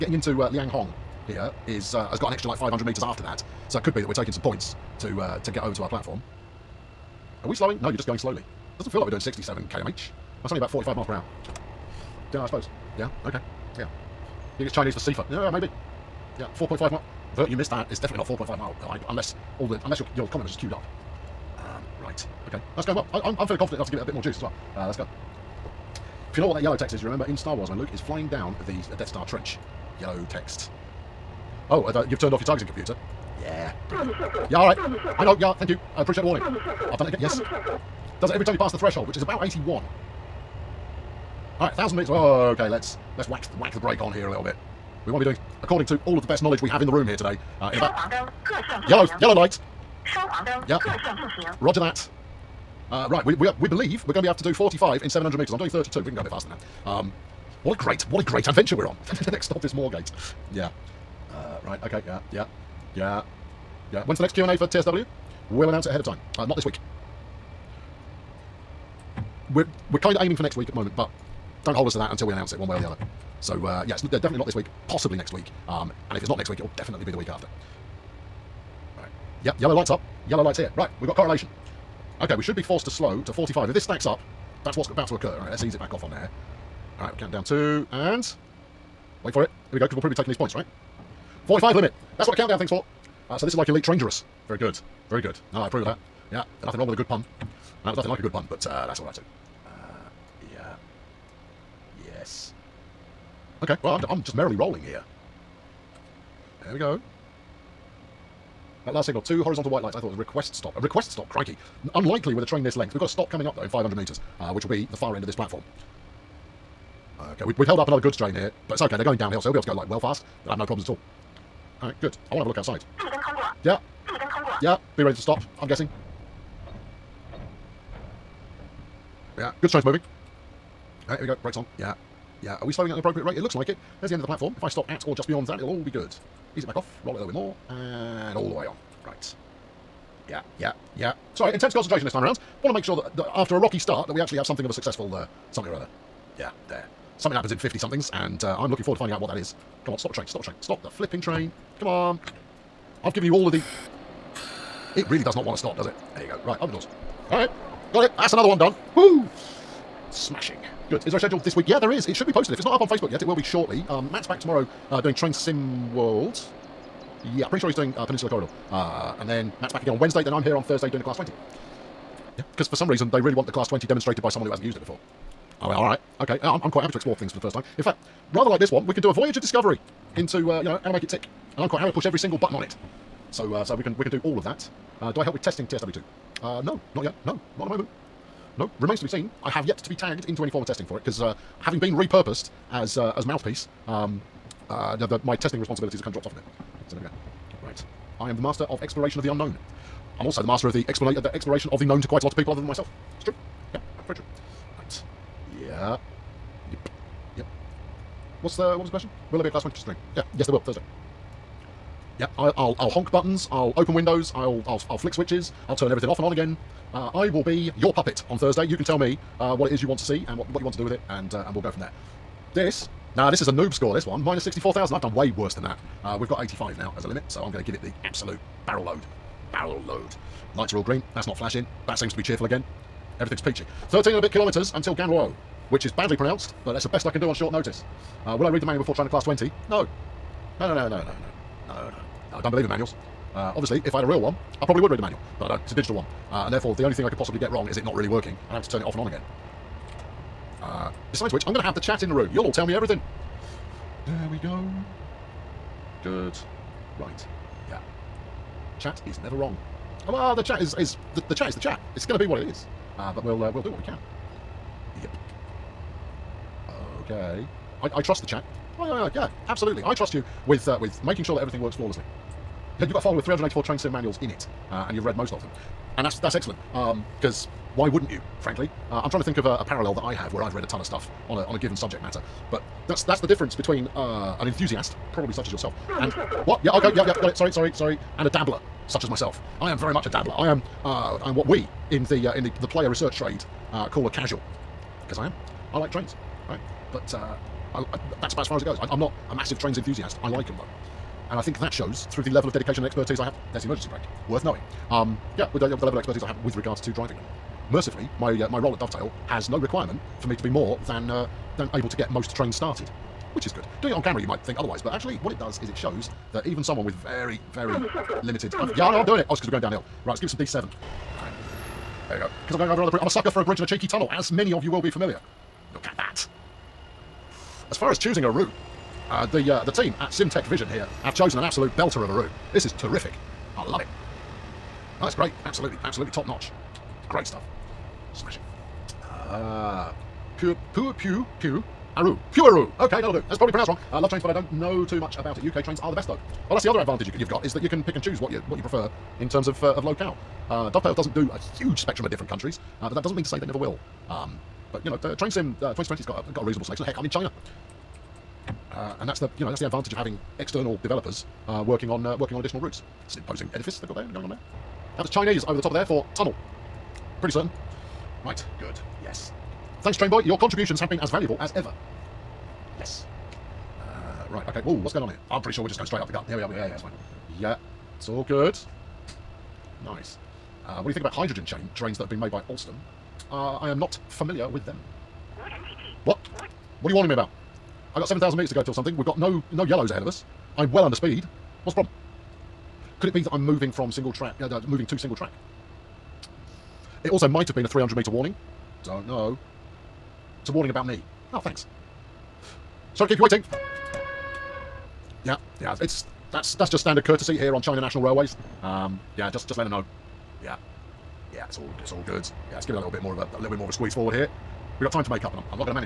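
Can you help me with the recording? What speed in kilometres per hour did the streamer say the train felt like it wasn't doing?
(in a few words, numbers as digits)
67.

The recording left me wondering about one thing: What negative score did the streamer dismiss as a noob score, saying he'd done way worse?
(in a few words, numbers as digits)
-64,000.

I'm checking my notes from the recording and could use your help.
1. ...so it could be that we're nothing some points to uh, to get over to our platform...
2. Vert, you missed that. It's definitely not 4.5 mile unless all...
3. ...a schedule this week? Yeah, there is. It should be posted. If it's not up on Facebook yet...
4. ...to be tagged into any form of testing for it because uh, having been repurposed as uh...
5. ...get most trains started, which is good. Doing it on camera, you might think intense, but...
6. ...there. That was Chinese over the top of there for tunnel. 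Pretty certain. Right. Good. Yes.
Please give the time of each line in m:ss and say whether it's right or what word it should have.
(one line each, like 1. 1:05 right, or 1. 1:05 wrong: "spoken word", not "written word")
1. 0:03 wrong: "taking", not "nothing"
2. 0:17 right
3. 2:41 right
4. 3:09 right
5. 5:11 wrong: "otherwise", not "intense"
6. 6:04 right.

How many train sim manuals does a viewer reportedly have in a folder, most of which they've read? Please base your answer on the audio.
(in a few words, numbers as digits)
384.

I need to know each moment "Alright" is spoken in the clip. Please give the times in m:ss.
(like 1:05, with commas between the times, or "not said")
2:01, 2:11.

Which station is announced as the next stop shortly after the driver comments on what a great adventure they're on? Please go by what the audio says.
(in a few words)
Moorgate.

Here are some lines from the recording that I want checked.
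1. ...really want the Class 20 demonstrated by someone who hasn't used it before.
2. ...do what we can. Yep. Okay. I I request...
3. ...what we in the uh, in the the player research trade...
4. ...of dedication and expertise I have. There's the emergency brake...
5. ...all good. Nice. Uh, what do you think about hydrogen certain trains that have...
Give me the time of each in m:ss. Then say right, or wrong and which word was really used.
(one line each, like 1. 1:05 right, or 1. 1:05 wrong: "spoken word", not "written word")
1. 2:53 right
2. 4:23 wrong: "trust", not "request"
3. 4:51 right
4. 5:02 right
5. 6:18 wrong: "chain", not "certain".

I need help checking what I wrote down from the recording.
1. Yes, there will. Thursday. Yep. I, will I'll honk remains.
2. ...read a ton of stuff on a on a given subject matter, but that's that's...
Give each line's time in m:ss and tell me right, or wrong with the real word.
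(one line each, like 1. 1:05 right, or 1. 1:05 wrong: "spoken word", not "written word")
1. 3:30 wrong: "buttons", not "remains"
2. 4:40 right.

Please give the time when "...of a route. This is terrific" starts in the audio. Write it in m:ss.
5:32.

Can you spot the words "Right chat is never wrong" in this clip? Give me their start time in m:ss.
4:16.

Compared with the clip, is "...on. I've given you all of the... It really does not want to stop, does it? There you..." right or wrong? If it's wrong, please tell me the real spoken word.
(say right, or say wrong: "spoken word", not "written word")
right.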